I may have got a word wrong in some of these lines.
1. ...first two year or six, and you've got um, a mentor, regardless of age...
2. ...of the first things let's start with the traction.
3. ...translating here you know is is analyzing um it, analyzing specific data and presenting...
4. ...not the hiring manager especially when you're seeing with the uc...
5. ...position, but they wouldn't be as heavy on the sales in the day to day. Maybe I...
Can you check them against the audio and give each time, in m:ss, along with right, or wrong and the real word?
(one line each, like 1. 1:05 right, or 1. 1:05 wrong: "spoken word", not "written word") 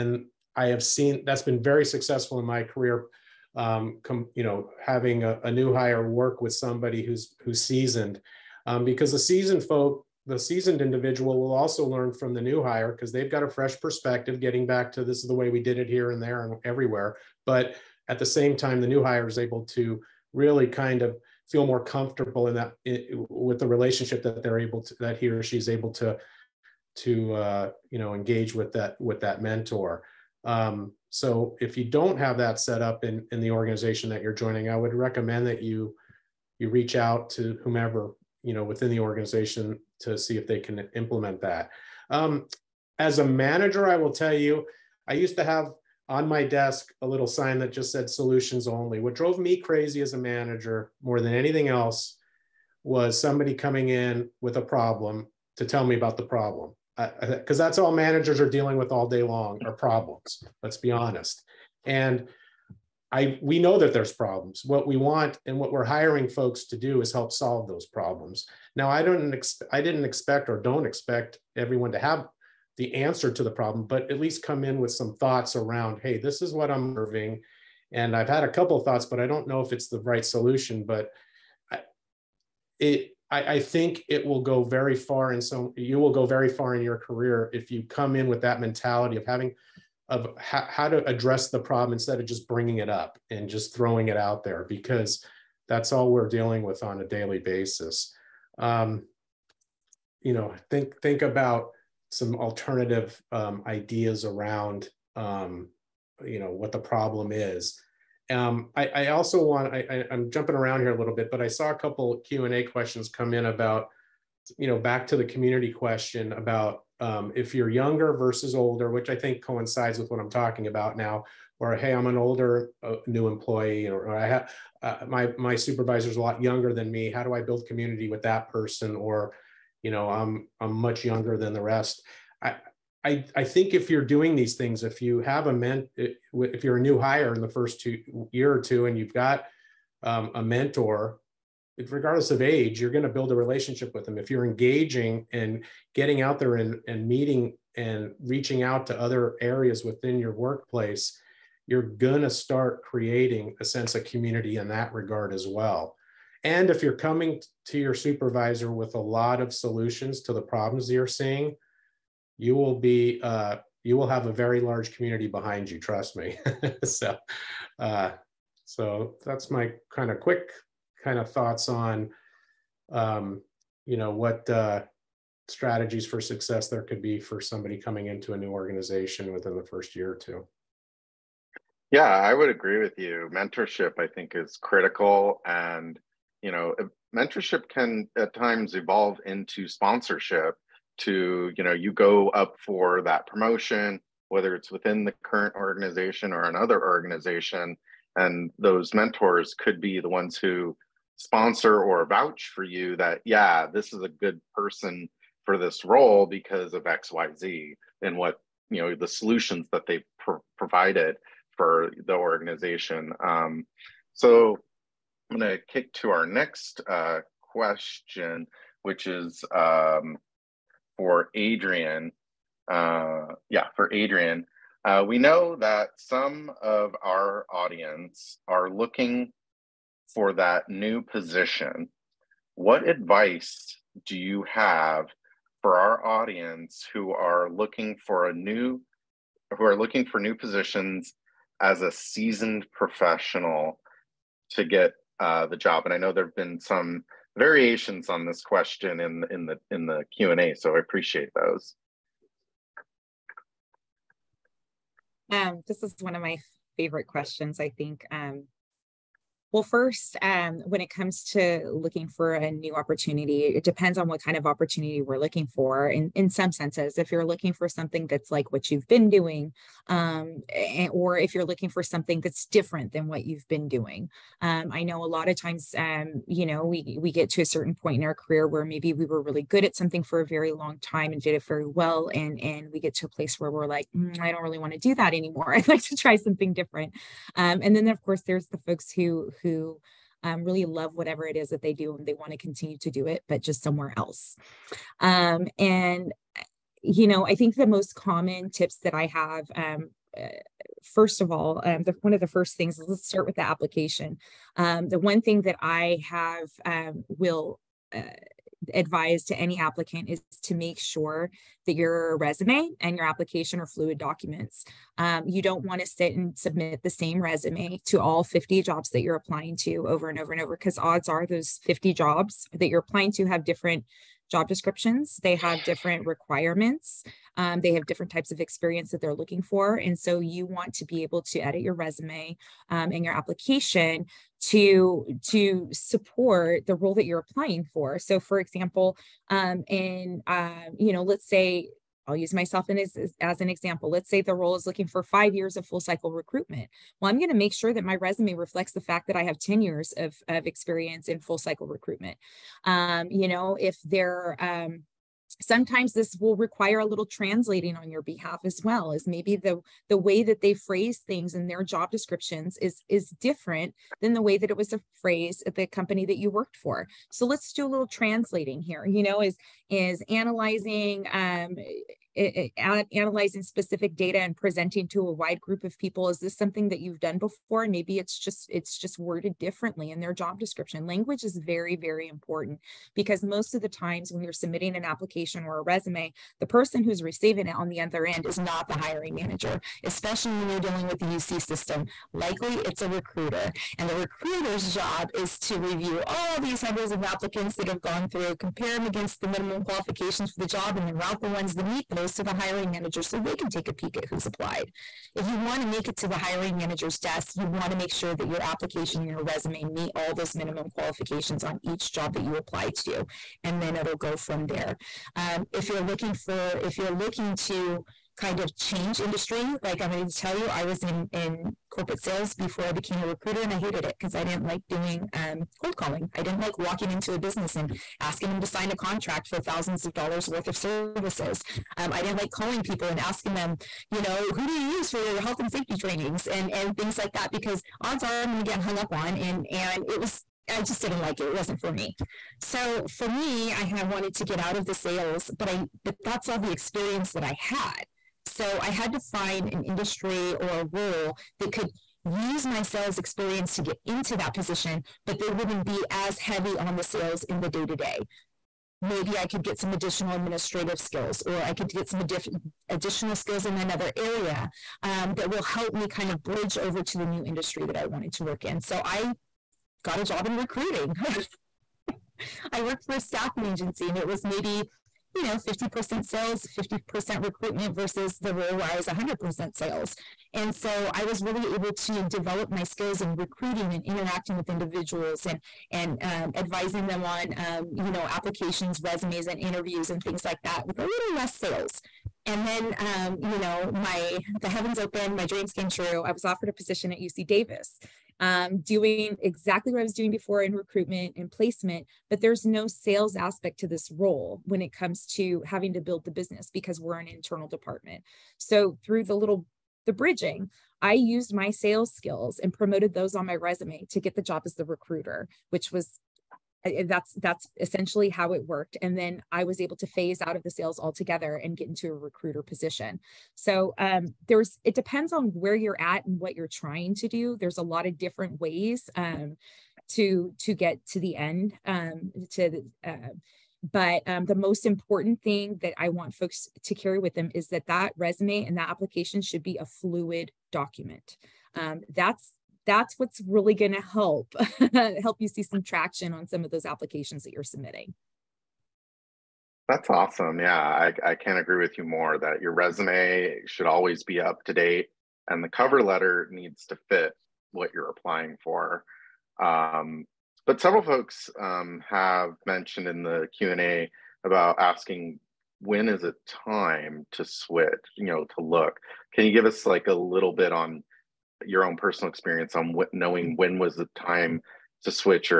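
1. 2:17 wrong: "two", not "six"
2. 5:02 wrong: "application", not "traction"
3. 6:07 right
4. 6:28 wrong: "dealing", not "seeing"
5. 7:34 right.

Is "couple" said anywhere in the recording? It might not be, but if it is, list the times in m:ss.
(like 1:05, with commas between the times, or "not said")
1:18, 1:51.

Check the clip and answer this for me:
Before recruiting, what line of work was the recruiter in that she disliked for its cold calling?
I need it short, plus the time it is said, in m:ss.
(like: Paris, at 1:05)
Corporate sales, at 7:01.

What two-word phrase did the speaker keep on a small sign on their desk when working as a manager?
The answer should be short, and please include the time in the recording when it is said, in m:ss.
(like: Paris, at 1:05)
Solutions only, at 0:48.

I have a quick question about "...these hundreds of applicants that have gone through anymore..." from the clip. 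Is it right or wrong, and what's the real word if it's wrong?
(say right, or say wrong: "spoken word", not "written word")
wrong: "compare", not "anymore".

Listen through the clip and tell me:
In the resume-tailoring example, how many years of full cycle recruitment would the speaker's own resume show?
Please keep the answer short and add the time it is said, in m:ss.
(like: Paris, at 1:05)
10, at 5:49.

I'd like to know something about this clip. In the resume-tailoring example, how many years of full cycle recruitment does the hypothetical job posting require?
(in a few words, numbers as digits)
5.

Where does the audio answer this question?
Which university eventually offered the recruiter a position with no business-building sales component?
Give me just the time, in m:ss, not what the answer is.
8:16.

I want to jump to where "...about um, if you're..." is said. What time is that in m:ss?
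1:56.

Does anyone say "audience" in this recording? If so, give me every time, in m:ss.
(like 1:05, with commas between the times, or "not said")
3:47, 3:56.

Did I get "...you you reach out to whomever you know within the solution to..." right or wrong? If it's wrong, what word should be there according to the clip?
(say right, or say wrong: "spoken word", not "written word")
wrong: "organization", not "solution".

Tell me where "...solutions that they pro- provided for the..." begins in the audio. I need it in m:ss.
3:29.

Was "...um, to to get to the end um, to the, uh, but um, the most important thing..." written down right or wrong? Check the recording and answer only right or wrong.
right.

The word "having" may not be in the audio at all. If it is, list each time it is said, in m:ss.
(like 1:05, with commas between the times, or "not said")
0:04, 1:29, 8:25.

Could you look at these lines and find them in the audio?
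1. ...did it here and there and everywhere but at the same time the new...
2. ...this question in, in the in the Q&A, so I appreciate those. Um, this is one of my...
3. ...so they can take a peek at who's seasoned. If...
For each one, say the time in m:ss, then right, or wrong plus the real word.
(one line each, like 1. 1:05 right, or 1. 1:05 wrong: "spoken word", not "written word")
1. 0:15 right
2. 4:08 right
3. 6:43 wrong: "applied", not "seasoned".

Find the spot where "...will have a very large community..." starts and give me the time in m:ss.
2:43.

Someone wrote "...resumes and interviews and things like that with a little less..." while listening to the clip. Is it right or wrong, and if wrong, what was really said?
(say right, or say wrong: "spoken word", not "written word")
right.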